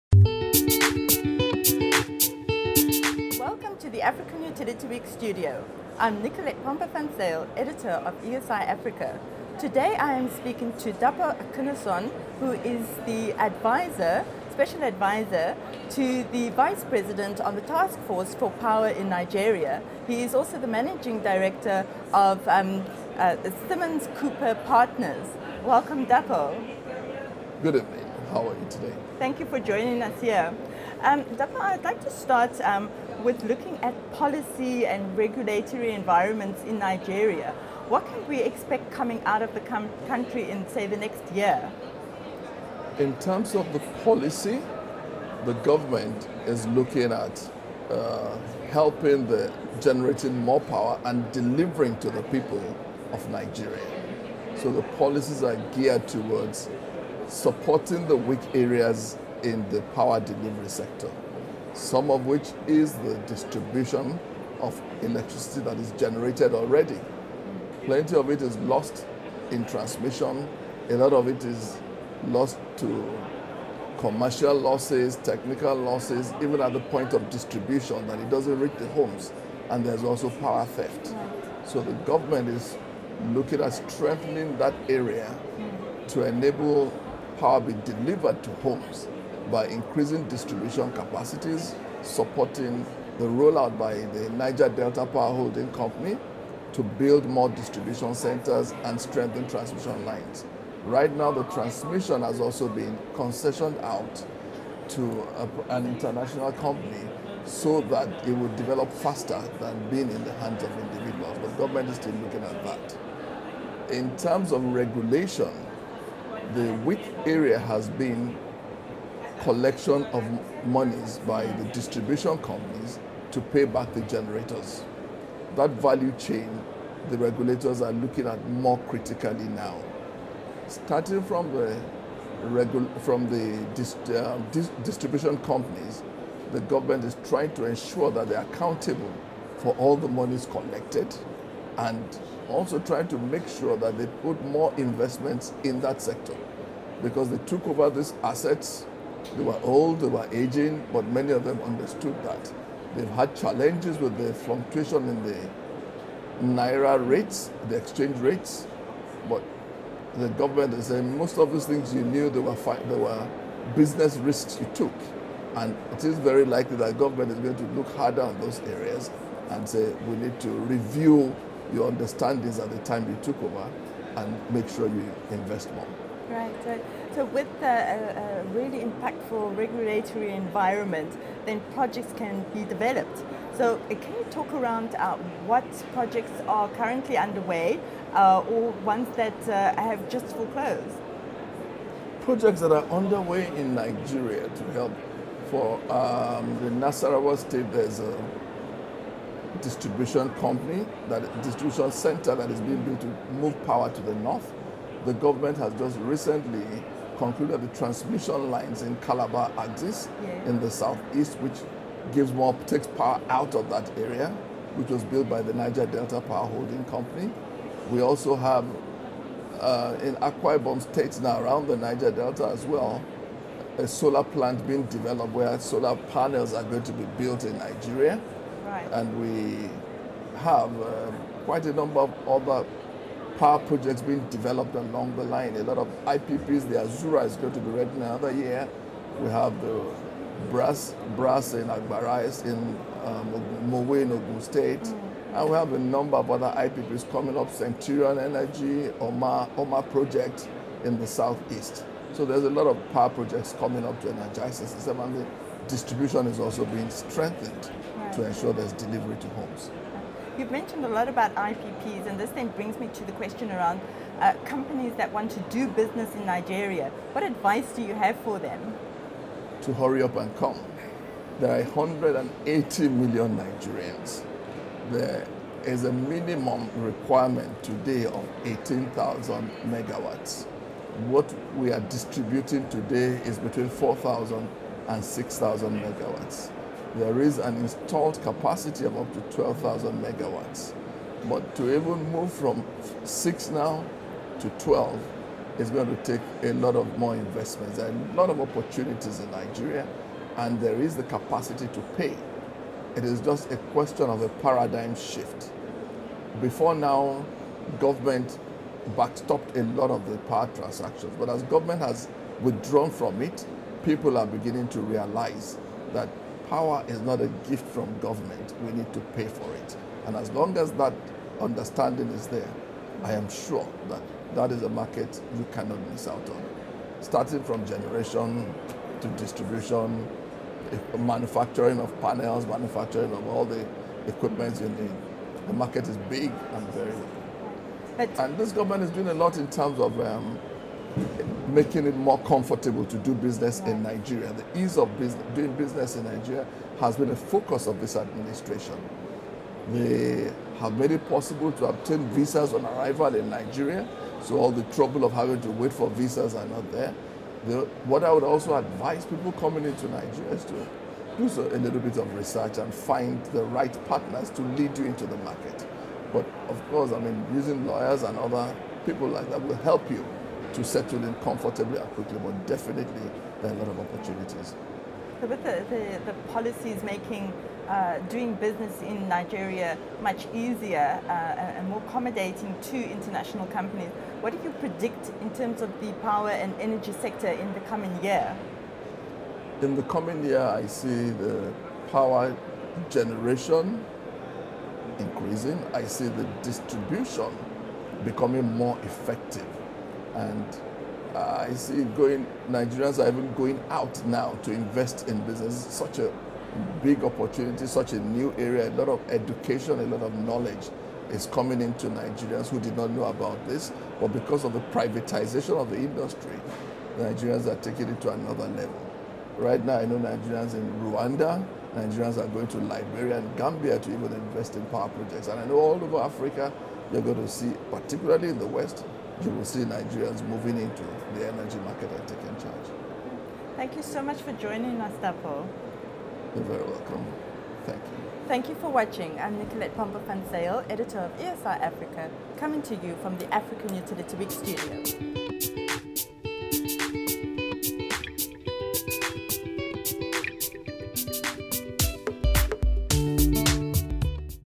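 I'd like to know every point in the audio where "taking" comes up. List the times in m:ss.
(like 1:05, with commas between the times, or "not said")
6:57, 7:12.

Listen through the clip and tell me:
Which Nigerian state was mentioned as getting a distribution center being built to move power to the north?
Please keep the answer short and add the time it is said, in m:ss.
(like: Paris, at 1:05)
Nasarawa, at 3:16.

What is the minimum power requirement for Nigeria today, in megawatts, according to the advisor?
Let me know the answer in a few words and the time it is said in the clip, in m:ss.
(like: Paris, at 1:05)
18,000 megawatts, at 4:38.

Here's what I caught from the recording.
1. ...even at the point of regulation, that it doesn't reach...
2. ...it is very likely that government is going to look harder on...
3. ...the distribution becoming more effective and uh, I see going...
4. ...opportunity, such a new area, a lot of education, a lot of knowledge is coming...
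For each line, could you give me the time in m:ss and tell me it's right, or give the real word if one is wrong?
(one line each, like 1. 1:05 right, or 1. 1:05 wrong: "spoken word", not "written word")
1. 1:16 wrong: "distribution", not "regulation"
2. 2:45 right
3. 6:36 right
4. 6:47 right.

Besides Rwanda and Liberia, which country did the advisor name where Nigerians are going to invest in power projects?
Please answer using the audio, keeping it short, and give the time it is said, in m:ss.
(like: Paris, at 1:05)
Gambia, at 7:03.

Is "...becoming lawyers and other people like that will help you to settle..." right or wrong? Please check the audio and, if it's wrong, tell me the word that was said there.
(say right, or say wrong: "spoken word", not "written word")
wrong: "using", not "becoming".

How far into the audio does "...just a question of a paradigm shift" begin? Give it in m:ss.
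5:03.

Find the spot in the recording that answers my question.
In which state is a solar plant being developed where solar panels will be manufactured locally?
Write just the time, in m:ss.
3:40.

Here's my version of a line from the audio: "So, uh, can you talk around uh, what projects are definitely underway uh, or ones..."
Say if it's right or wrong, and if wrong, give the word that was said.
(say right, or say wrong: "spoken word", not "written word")
wrong: "currently", not "definitely".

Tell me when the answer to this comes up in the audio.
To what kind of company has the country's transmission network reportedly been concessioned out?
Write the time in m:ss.
1:45.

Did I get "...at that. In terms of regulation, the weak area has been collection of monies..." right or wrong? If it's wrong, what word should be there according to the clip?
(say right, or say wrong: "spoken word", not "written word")
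right.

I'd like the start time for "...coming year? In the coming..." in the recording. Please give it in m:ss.
6:27.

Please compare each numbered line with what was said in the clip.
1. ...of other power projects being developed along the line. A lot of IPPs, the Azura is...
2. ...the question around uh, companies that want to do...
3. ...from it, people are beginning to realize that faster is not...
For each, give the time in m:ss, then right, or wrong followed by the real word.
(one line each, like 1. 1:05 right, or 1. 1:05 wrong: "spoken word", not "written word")
1. 3:52 right
2. 4:23 right
3. 5:12 wrong: "power", not "faster".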